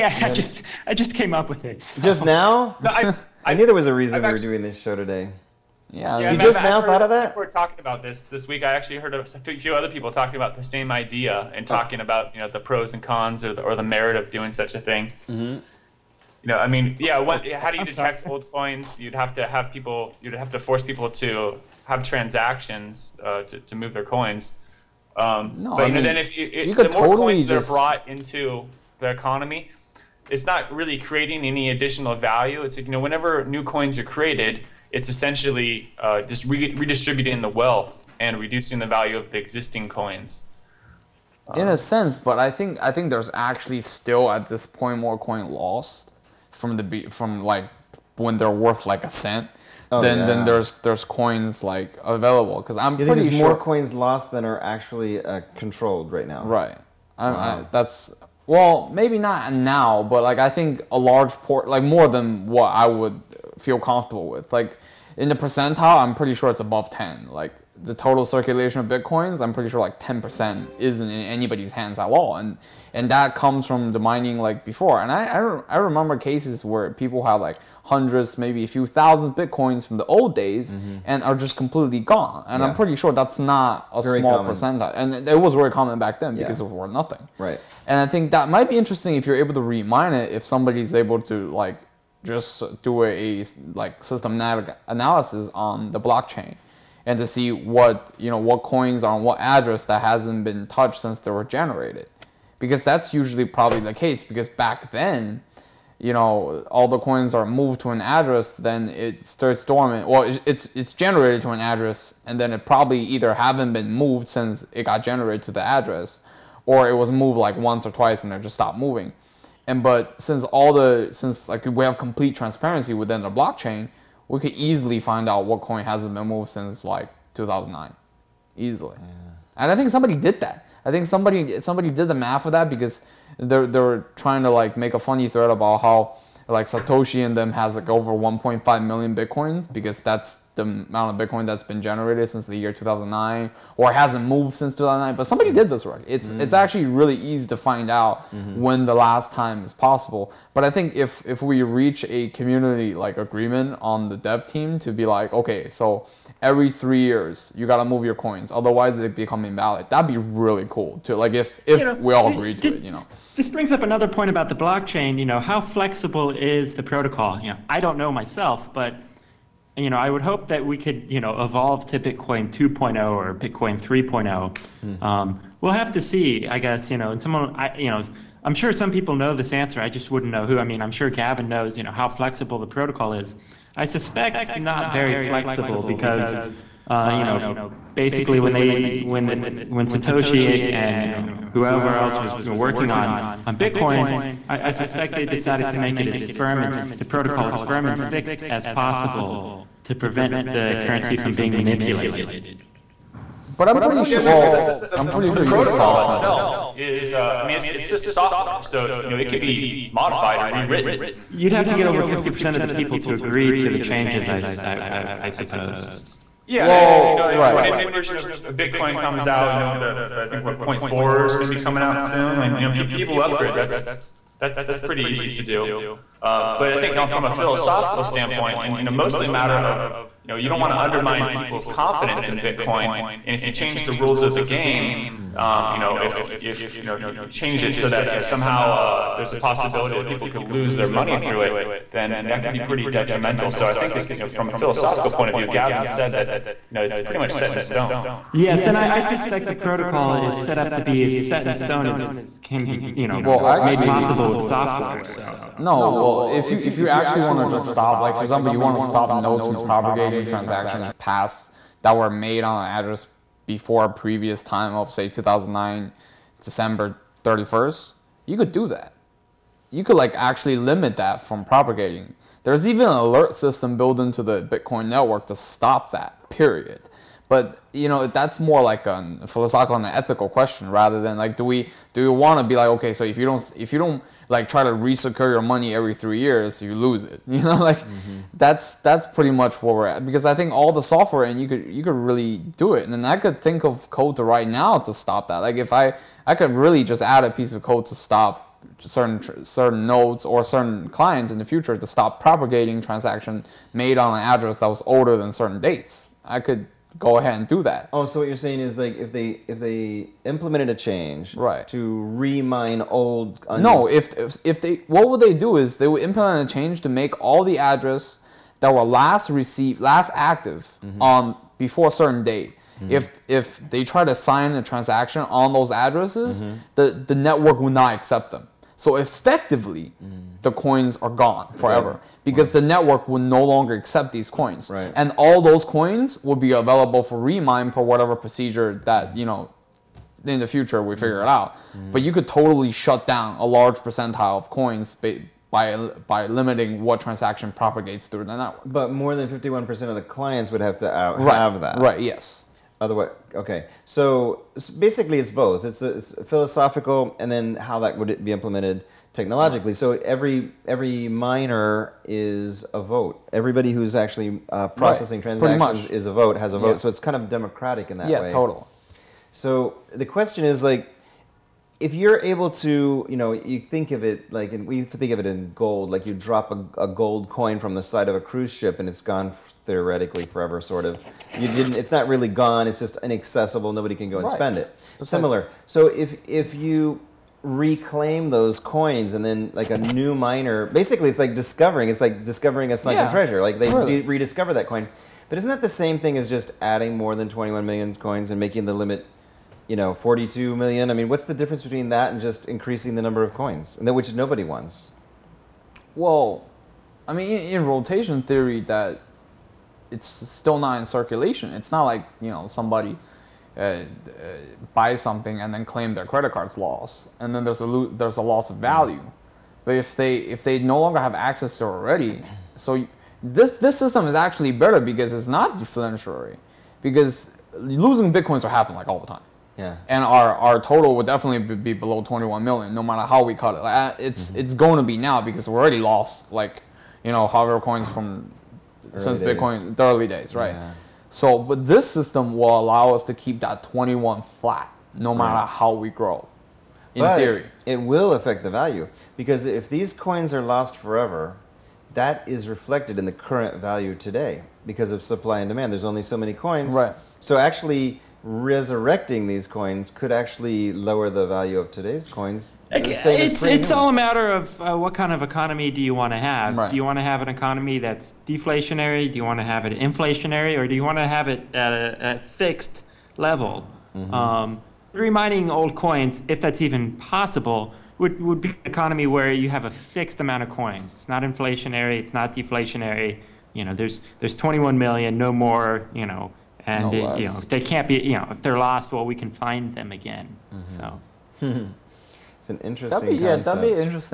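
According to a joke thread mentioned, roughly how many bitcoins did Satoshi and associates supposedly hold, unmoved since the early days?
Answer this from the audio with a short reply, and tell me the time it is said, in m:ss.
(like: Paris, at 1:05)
1.5 million, at 2:18.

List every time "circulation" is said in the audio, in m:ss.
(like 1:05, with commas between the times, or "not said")
1:08, 6:50.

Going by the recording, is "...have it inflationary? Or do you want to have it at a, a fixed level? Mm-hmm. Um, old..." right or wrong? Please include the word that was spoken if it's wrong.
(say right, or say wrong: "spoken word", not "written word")
right.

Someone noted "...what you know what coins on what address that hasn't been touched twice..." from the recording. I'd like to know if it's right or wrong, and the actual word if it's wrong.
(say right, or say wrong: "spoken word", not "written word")
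wrong: "since", not "twice".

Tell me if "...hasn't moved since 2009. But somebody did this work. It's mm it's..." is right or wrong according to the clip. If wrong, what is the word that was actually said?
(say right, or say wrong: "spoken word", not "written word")
right.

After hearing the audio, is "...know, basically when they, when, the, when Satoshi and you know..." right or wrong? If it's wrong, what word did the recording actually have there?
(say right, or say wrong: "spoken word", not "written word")
right.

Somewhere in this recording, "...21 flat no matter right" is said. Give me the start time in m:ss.
7:23.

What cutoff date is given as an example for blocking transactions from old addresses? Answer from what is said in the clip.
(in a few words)
December 31, 2009.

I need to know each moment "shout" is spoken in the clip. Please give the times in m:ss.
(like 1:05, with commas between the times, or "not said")
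not said.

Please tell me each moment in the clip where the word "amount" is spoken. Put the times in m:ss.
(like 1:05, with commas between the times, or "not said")
2:20, 8:00.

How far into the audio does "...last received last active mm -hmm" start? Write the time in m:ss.
5:18.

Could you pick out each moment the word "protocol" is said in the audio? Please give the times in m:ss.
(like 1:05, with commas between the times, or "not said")
2:46, 3:02, 3:17, 3:25, 4:09.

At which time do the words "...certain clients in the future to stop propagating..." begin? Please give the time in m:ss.
5:00.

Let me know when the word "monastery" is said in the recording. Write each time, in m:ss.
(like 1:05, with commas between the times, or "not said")
not said.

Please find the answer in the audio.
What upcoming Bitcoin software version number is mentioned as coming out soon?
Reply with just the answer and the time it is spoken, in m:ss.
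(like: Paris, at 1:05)
0.4, at 3:40.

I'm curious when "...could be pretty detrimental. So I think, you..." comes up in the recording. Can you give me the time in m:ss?
4:02.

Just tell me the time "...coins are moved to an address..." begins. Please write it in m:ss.
1:46.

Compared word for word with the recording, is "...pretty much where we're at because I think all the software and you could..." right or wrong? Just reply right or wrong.
right.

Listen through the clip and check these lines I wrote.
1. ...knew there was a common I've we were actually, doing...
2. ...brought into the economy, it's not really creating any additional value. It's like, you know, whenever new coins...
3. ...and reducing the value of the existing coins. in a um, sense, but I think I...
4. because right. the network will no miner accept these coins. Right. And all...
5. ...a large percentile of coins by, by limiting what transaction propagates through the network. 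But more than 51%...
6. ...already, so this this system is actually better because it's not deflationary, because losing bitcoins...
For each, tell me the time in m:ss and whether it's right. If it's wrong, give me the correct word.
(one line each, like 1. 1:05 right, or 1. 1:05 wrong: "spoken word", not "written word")
1. 0:03 wrong: "reason", not "common"
2. 0:27 right
3. 0:38 right
4. 5:32 wrong: "longer", not "miner"
5. 5:43 right
6. 7:01 right.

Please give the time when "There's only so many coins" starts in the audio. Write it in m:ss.
7:35.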